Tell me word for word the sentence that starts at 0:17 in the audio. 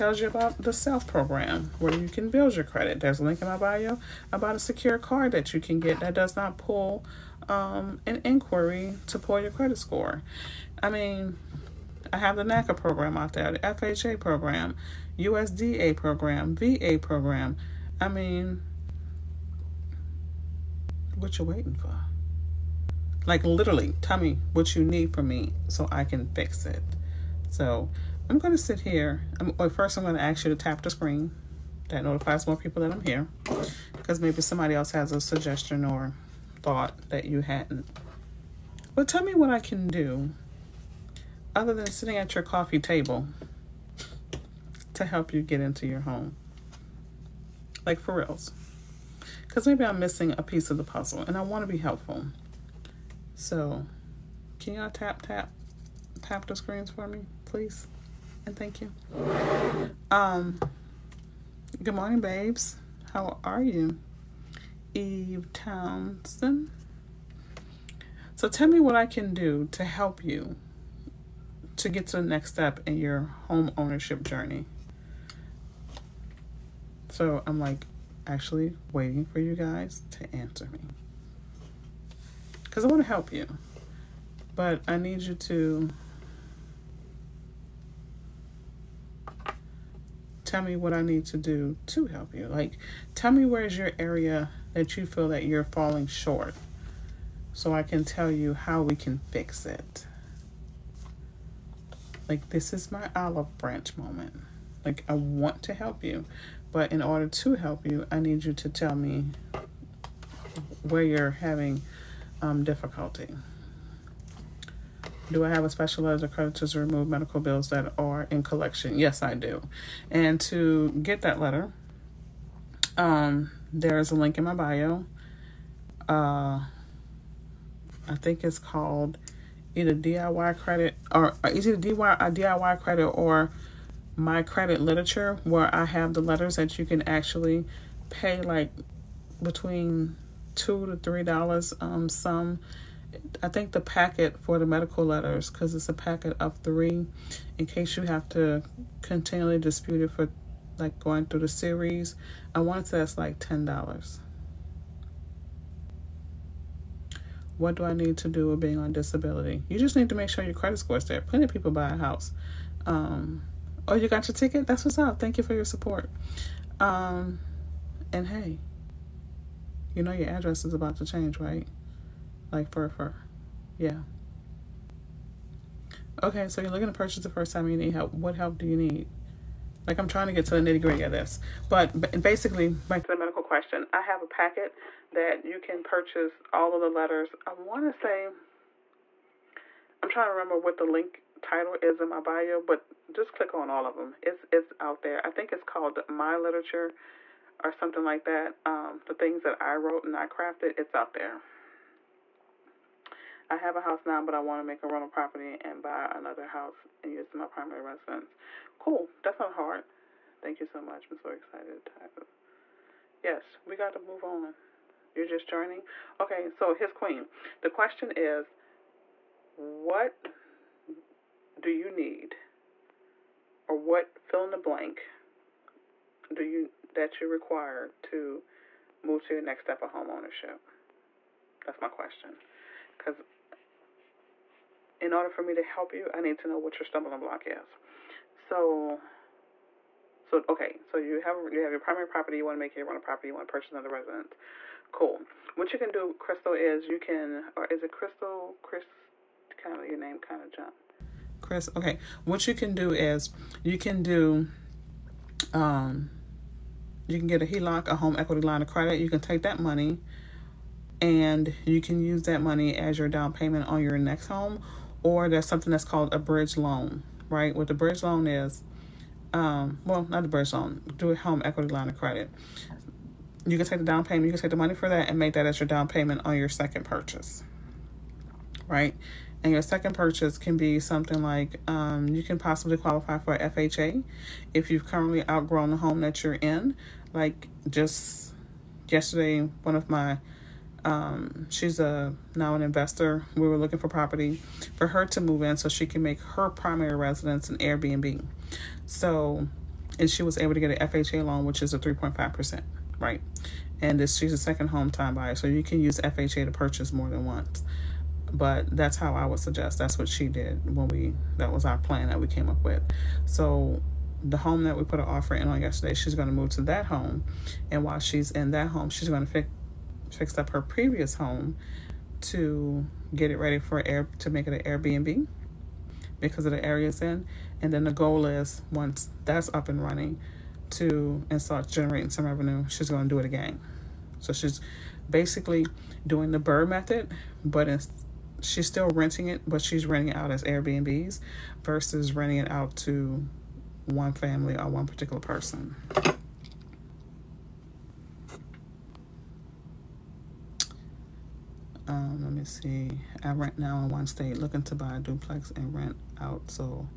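I mean, what you waiting for?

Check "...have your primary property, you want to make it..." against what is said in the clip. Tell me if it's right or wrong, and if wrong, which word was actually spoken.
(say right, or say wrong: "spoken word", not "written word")
right.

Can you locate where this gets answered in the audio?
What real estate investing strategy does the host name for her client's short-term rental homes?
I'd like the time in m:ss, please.
5:36.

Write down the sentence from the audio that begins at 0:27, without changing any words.
So I'm going to sit here.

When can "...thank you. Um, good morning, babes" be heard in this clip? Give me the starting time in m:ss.
0:58.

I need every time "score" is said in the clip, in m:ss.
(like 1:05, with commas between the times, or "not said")
0:09, 2:40.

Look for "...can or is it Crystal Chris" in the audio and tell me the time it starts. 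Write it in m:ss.
4:06.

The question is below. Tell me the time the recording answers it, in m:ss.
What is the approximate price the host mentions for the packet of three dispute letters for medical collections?
2:33.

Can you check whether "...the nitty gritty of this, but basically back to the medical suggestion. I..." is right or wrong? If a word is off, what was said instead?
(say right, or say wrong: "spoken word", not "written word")
wrong: "question", not "suggestion".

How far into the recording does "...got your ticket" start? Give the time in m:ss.
2:44.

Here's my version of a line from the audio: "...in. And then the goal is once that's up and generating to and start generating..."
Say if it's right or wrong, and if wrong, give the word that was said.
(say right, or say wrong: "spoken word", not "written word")
wrong: "running", not "generating".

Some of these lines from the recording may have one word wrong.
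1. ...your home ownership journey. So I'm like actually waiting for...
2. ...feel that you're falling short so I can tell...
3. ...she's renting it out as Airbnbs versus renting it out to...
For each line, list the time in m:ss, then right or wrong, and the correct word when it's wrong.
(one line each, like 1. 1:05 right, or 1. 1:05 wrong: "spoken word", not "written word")
1. 1:12 right
2. 1:35 right
3. 5:39 right.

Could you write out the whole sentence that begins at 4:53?
We were looking for property for her to move in so she can make her primary residence an Airbnb.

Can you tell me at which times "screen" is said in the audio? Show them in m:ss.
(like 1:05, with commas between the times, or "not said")
0:30, 0:56.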